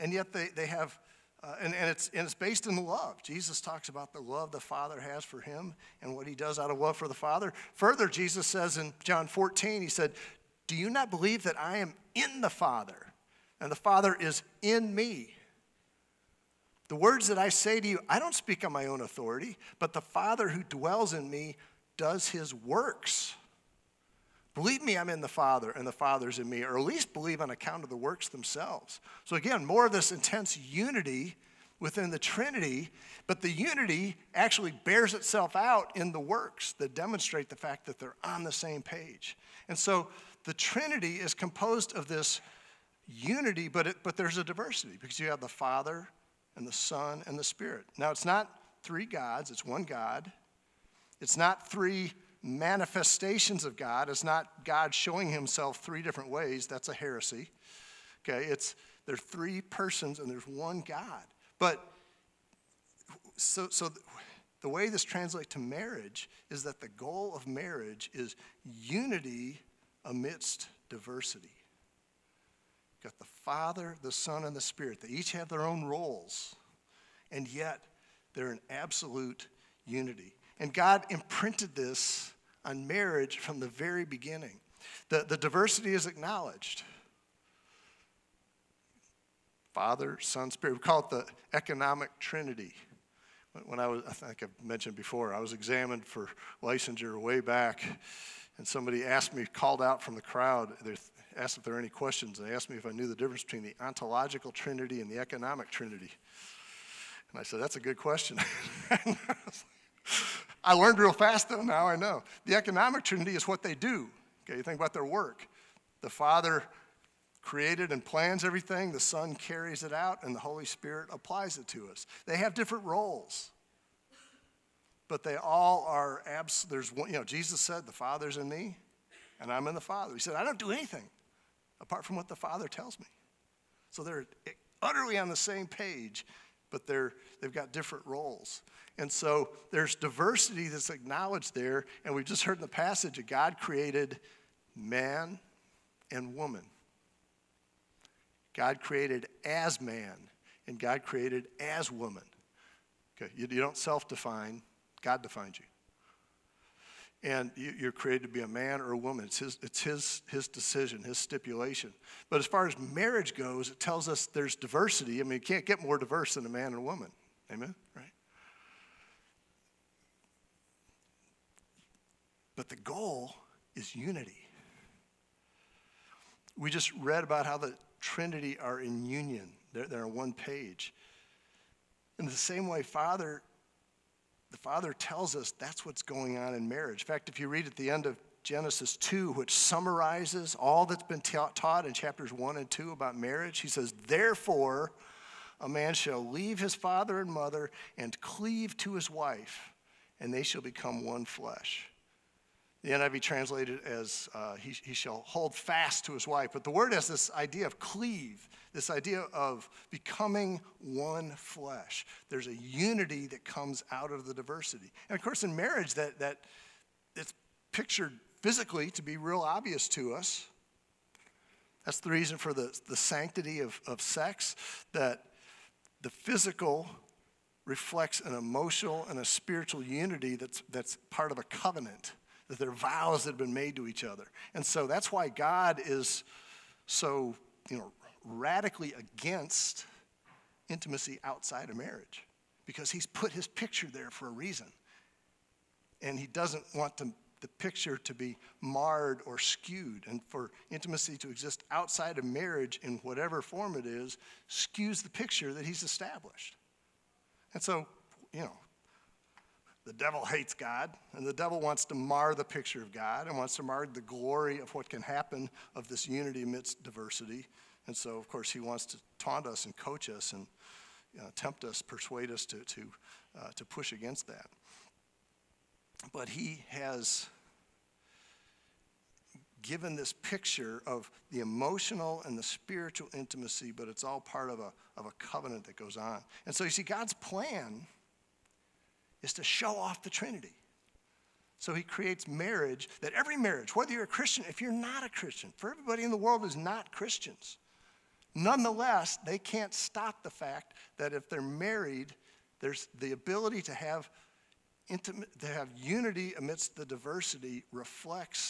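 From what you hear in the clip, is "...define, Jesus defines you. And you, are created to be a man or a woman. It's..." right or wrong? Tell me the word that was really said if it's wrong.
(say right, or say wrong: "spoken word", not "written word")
wrong: "God", not "Jesus".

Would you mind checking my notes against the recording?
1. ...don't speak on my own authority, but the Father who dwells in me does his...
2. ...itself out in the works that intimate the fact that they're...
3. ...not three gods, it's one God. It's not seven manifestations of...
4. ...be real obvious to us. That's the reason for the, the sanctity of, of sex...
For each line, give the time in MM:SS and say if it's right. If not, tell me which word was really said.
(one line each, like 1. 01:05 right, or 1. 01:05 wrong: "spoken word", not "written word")
1. 00:18 right
2. 00:35 wrong: "demonstrate", not "intimate"
3. 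00:48 wrong: "three", not "seven"
4. 03:39 right.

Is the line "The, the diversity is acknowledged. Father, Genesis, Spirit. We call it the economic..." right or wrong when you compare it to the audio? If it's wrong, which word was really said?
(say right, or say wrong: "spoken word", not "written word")
wrong: "Son", not "Genesis".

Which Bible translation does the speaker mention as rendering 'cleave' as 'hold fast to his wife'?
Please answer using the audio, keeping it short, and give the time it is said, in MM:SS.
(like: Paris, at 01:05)
NIV, at 03:22.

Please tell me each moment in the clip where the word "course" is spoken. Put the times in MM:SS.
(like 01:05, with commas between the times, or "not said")
03:35, 04:28.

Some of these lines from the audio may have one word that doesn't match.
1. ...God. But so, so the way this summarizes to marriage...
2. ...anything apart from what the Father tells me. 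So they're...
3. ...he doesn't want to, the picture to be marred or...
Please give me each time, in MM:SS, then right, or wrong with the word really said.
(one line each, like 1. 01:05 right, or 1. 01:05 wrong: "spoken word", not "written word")
1. 01:00 wrong: "translates", not "summarizes"
2. 02:10 right
3. 04:06 right.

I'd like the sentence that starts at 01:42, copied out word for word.
They asked me if I knew the difference between the ontological trinity and the economic trinity.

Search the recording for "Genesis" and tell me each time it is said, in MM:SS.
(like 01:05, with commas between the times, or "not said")
03:08.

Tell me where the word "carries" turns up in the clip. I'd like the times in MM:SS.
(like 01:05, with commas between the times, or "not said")
01:59.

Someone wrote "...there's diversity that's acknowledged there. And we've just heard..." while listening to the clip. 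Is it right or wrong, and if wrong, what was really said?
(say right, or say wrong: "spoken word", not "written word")
right.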